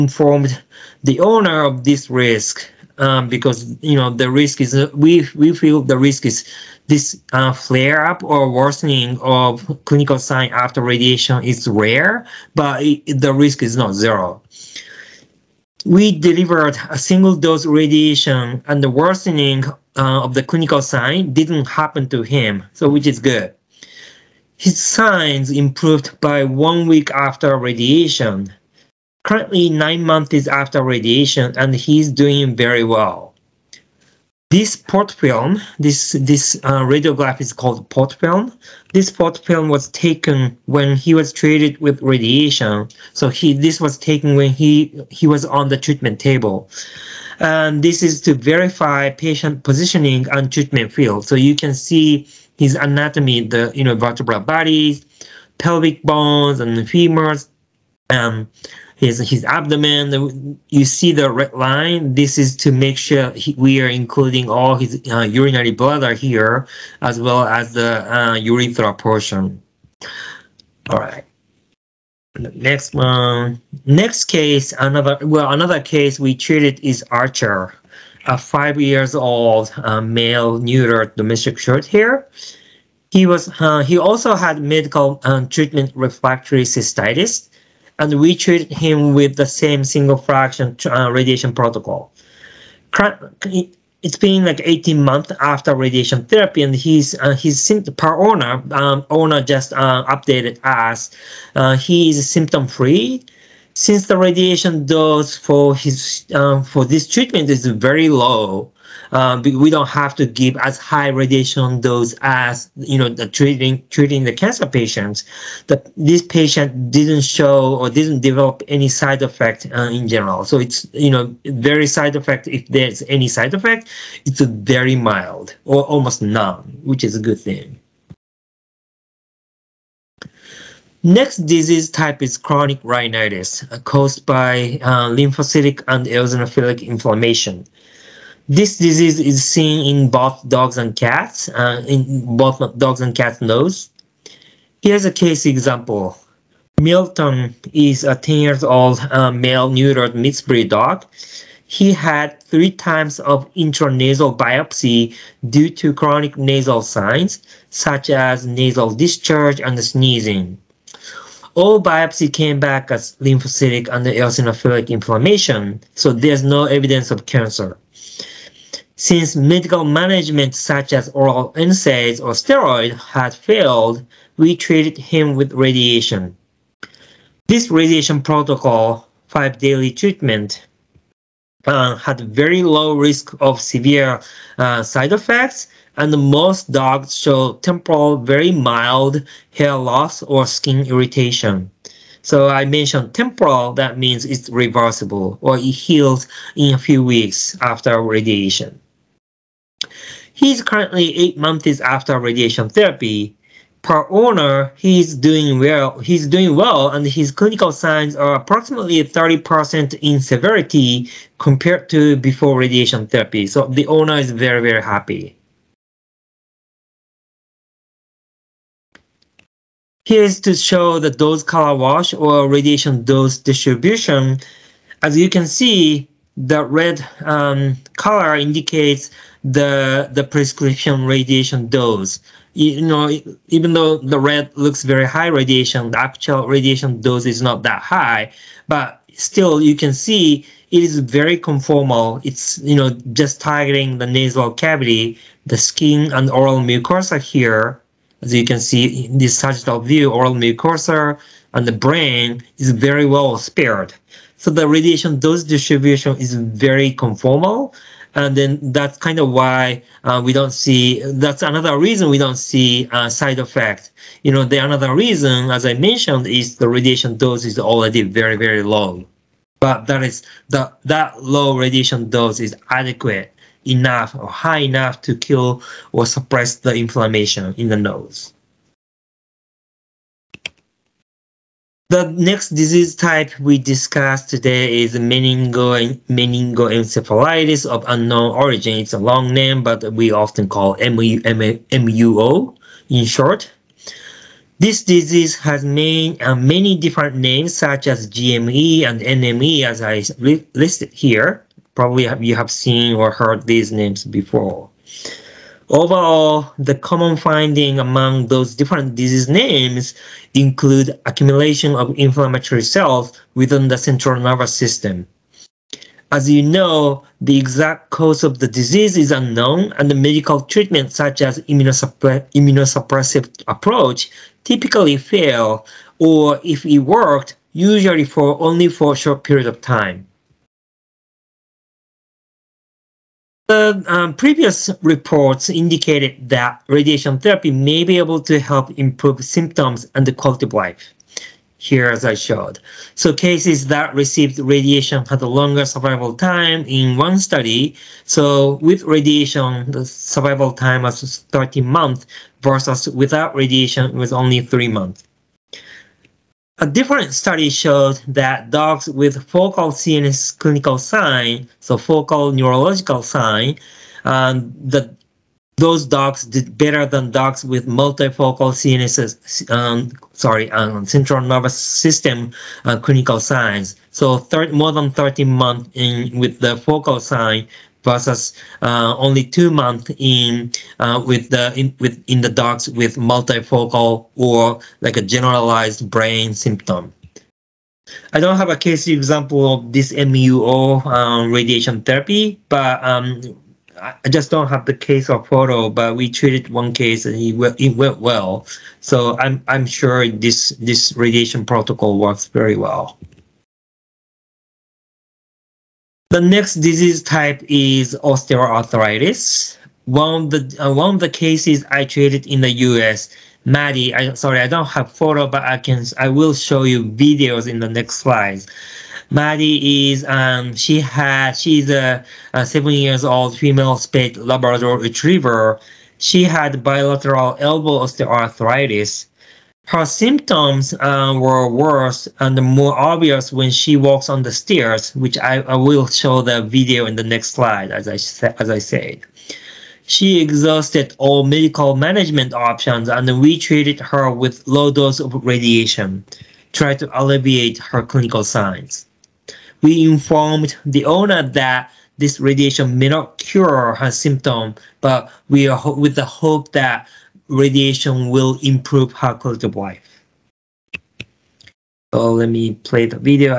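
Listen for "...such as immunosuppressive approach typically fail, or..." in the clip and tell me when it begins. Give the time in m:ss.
5:20.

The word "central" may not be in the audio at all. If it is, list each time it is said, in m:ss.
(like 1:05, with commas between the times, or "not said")
5:13, 6:10.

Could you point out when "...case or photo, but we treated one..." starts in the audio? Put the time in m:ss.
6:34.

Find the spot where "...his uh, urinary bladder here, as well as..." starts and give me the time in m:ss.
1:04.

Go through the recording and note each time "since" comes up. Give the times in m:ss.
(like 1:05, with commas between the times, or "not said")
1:43, 2:49.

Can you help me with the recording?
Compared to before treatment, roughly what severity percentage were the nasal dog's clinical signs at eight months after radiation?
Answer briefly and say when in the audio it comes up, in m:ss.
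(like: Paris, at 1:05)
30%, at 3:29.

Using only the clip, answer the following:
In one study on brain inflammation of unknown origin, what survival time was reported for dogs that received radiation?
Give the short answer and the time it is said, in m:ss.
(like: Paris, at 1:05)
13 months, at 5:51.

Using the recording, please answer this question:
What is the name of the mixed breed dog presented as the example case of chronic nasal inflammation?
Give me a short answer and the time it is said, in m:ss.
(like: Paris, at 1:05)
Milton, at 2:26.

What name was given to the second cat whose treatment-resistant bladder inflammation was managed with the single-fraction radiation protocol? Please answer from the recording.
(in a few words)
Archer.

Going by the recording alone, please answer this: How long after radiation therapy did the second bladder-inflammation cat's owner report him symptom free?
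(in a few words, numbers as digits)
18 months.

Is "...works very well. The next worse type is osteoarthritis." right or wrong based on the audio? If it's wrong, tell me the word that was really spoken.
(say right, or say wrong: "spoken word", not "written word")
wrong: "disease", not "worse".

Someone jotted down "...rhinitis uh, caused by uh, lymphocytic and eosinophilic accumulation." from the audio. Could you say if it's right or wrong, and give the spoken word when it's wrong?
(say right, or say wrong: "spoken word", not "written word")
wrong: "inflammation", not "accumulation".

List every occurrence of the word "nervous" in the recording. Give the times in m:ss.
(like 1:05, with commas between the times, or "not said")
5:14, 6:11.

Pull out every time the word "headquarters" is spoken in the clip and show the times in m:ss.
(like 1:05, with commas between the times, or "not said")
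not said.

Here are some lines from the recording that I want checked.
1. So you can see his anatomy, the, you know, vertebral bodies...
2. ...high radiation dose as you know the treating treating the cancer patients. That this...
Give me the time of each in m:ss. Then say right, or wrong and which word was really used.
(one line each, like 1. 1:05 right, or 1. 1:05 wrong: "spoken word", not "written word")
1. 0:51 right
2. 1:50 right.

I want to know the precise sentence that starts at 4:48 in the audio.
It's a long name, but we often call MUO in short.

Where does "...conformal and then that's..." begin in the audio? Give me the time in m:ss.
4:16.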